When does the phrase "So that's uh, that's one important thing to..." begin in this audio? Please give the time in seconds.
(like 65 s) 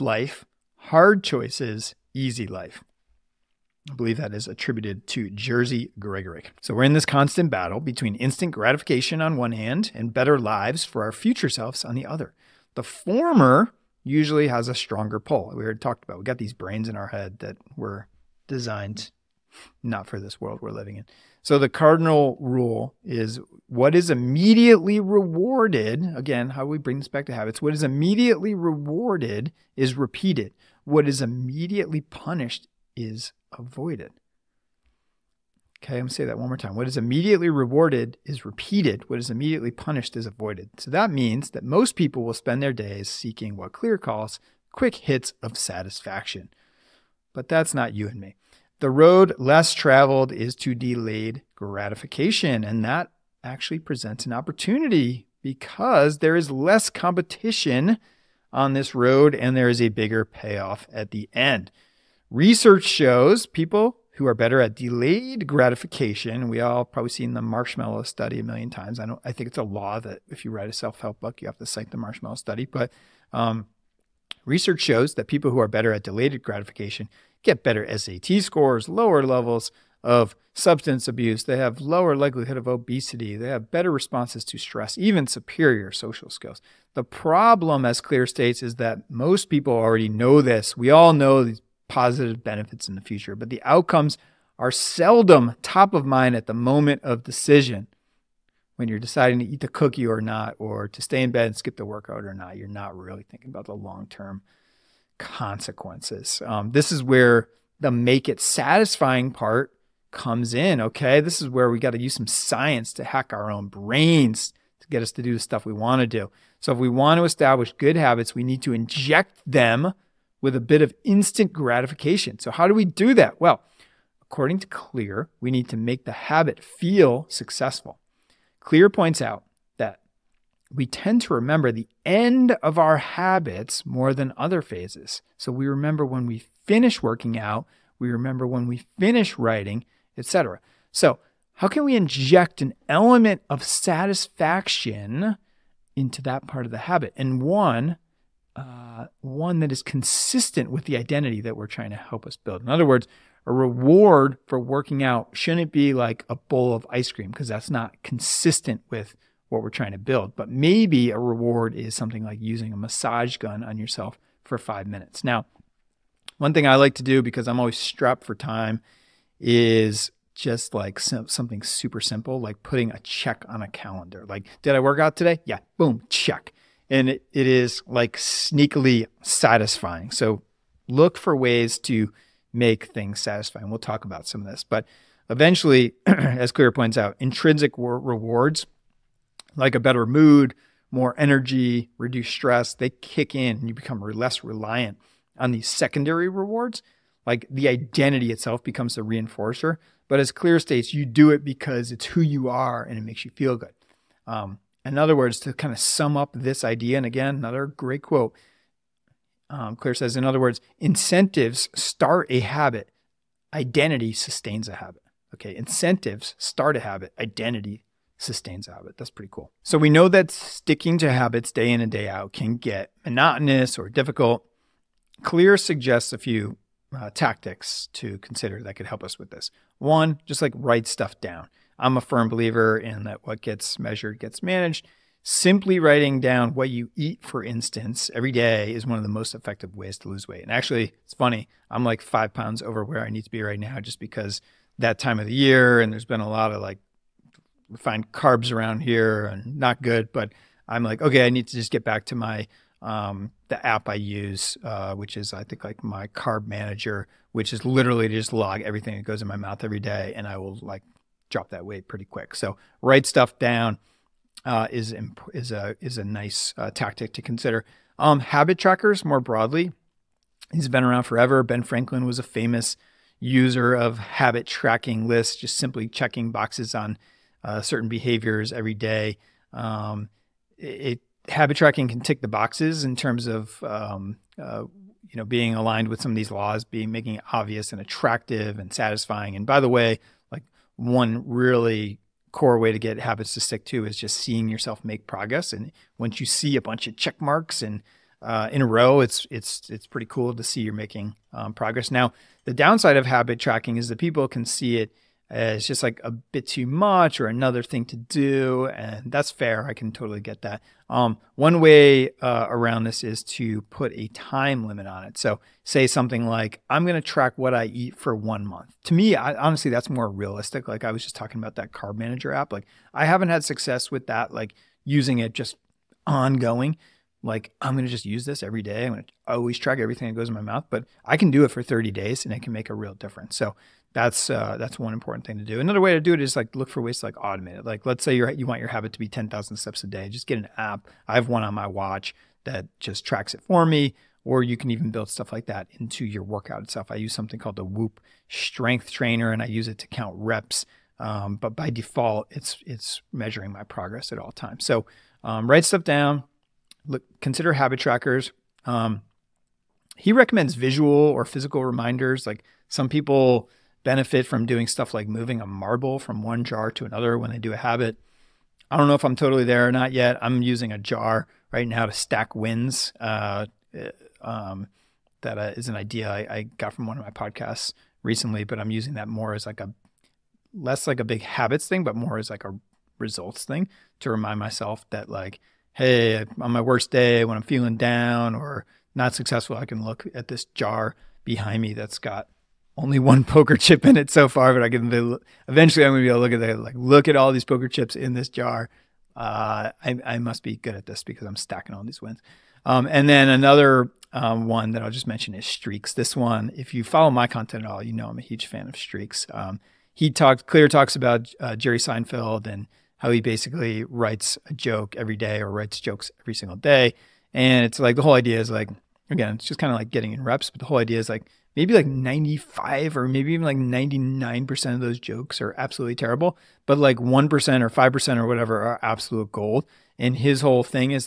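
333 s.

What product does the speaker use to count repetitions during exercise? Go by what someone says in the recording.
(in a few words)
Whoop Strength Trainer.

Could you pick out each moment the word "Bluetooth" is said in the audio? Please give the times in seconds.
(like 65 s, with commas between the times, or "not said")
not said.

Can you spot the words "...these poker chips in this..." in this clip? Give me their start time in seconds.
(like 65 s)
397 s.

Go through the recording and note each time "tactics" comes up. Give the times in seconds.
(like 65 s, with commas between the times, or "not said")
227 s, 266 s.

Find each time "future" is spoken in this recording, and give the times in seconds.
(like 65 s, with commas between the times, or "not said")
11 s, 93 s.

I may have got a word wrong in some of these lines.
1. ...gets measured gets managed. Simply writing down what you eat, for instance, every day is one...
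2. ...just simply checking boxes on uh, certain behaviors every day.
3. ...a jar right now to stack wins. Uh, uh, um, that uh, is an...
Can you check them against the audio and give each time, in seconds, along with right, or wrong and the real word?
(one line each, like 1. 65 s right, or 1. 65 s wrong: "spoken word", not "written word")
1. 233 s right
2. 275 s right
3. 370 s right.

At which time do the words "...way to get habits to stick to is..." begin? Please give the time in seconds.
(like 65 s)
292 s.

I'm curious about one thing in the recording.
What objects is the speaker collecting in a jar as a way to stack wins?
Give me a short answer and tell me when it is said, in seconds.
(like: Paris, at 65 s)
poker chips, at 393 s.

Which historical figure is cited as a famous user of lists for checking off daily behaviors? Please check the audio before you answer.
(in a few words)
Ben Franklin.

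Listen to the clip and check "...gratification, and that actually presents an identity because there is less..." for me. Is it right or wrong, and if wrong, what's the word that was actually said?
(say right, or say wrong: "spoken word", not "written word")
wrong: "opportunity", not "identity".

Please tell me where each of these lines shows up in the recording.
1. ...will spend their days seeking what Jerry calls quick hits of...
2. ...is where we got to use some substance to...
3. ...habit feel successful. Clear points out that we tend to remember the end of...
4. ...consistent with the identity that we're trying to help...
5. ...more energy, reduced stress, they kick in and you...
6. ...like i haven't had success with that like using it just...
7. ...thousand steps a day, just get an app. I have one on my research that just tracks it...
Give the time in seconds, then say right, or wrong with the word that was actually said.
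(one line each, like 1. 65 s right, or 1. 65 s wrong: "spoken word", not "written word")
1. 42 s wrong: "Clear", not "Jerry"
2. 111 s wrong: "science", not "substance"
3. 126 s right
4. 149 s right
5. 190 s right
6. 322 s right
7. 339 s wrong: "watch", not "research".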